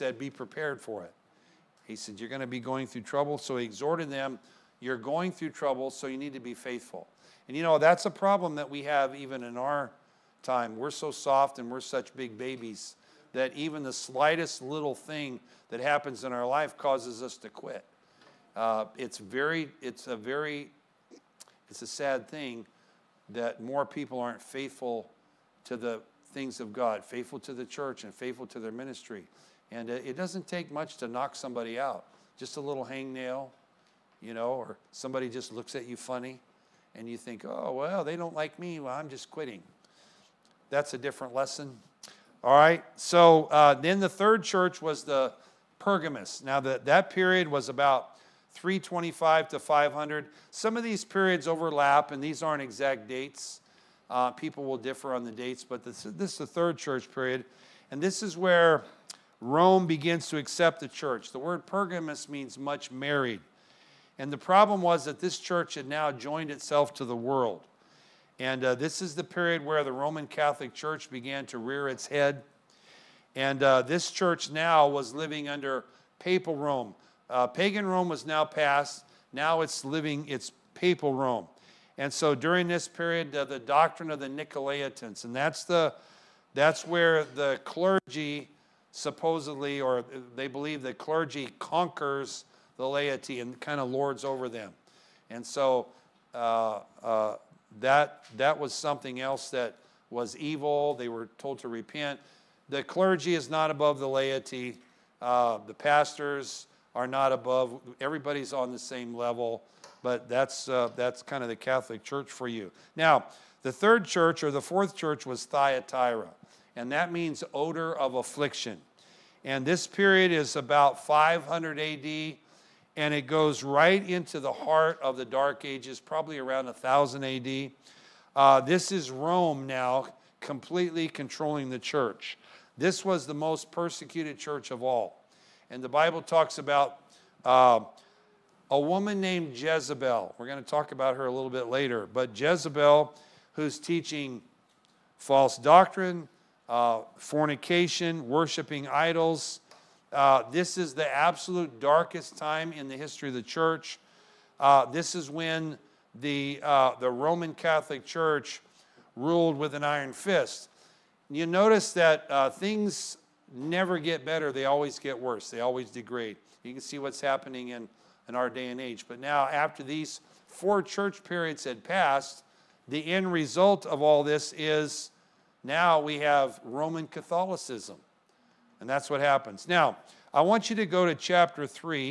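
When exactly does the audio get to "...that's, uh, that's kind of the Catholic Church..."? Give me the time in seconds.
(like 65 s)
110 s.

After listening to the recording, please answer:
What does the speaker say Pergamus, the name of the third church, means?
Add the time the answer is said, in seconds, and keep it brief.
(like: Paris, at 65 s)
Much married, at 62 s.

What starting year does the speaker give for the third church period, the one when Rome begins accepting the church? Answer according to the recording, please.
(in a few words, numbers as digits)
325.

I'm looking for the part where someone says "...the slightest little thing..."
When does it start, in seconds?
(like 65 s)
13 s.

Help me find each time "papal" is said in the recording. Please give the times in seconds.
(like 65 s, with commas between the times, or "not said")
76 s, 80 s.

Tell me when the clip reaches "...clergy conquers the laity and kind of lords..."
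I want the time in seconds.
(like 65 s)
90 s.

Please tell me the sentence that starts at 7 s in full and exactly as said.
And you know, that's a problem that we have even in our time.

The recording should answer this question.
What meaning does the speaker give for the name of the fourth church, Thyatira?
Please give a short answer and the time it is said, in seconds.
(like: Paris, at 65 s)
Odor of affliction, at 117 s.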